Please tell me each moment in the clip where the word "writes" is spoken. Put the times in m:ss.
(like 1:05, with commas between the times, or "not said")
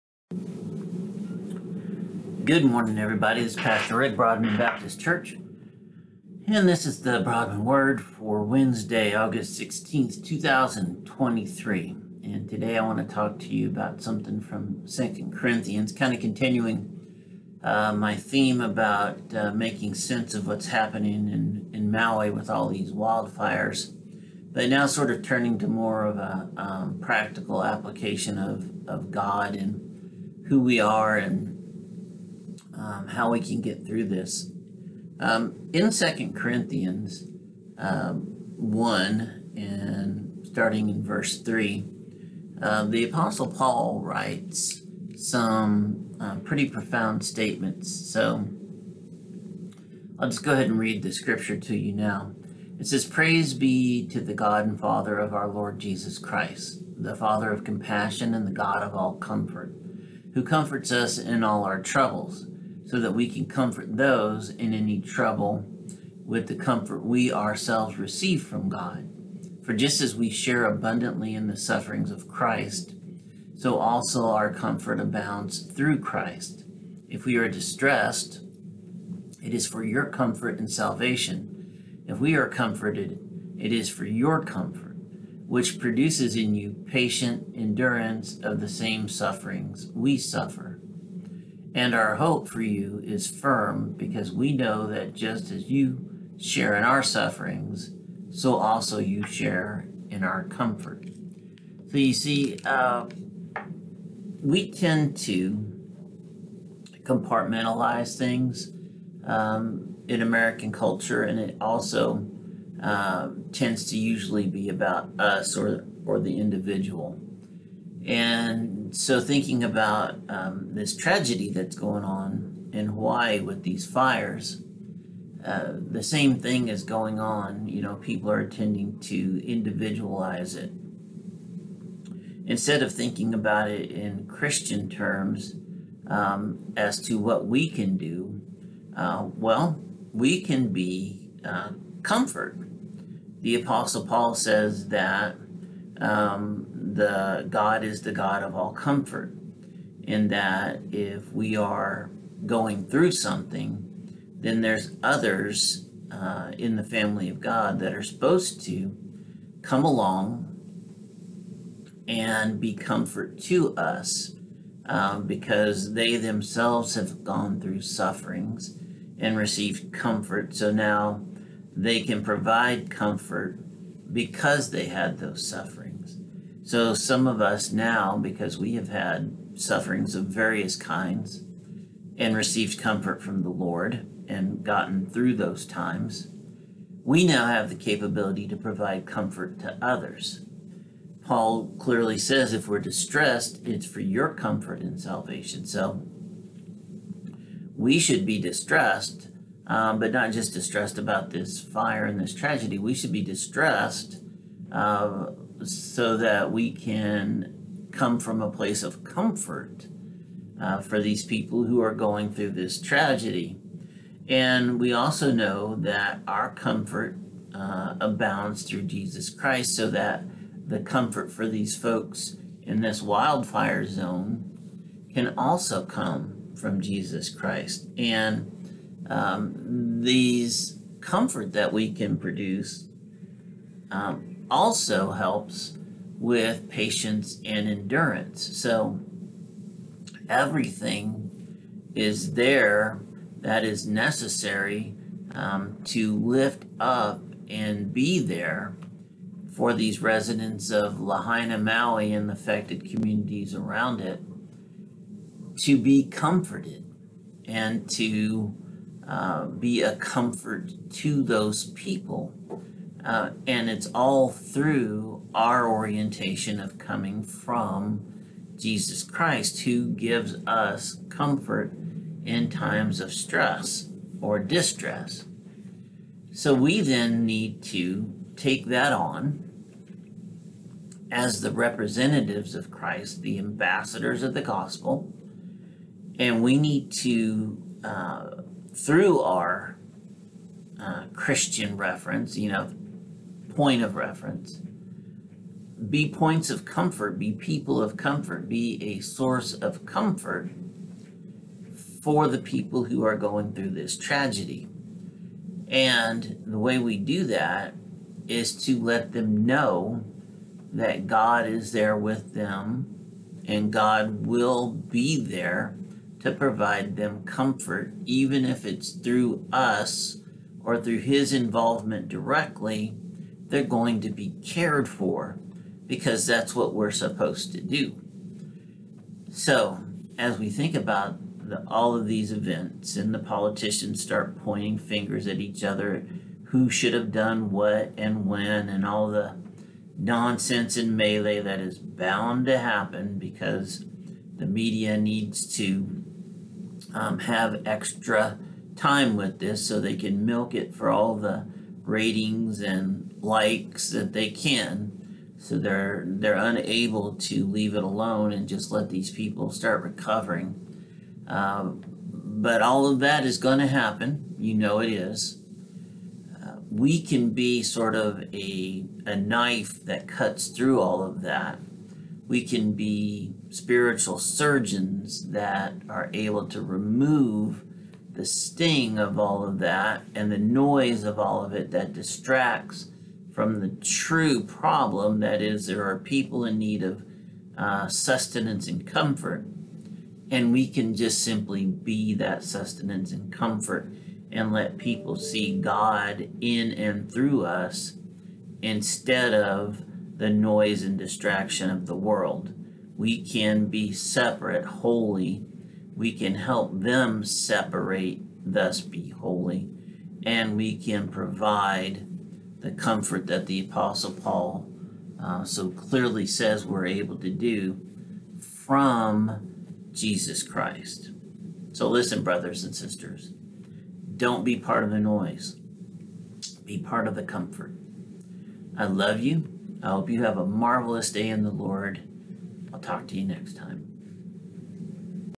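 0:44.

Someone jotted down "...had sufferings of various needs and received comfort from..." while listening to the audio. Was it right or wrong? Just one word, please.
wrong.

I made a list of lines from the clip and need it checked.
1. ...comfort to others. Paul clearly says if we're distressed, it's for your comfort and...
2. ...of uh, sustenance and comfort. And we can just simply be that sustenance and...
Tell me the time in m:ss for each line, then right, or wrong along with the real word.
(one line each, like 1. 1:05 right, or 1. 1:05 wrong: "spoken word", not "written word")
1. 3:09 right
2. 6:26 right.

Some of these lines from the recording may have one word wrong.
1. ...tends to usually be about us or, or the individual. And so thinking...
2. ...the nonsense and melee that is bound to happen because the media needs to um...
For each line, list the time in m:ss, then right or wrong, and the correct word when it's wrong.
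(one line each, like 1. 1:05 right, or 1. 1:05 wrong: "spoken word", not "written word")
1. 1:53 right
2. 5:39 right.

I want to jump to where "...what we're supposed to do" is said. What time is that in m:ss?
5:26.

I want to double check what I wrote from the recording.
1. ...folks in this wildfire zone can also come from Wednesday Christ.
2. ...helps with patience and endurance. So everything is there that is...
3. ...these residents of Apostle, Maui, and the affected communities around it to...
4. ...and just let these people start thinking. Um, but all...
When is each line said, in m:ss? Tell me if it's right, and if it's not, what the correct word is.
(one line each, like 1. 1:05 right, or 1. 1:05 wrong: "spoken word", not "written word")
1. 3:41 wrong: "Jesus", not "Wednesday"
2. 3:55 right
3. 4:09 wrong: "Lahaina", not "Apostle"
4. 5:58 wrong: "recovering", not "thinking".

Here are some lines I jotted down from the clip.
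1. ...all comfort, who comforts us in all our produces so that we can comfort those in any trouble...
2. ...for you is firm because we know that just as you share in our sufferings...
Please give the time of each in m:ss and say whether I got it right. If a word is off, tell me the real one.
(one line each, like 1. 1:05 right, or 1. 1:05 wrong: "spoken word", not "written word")
1. 0:58 wrong: "troubles", not "produces"
2. 1:32 right.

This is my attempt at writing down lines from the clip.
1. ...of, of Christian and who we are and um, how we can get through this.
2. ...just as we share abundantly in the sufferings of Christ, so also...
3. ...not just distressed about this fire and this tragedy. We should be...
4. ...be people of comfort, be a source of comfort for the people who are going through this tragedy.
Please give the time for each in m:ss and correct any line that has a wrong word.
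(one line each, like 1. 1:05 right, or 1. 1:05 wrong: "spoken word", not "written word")
1. 0:28 wrong: "God", not "Christian"
2. 1:09 right
3. 3:20 right
4. 4:57 right.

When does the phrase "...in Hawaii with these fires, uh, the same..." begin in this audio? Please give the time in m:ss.
2:02.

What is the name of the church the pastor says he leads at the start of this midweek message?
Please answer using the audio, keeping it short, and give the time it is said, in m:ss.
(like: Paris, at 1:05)
Broadman Baptist Church, at 0:04.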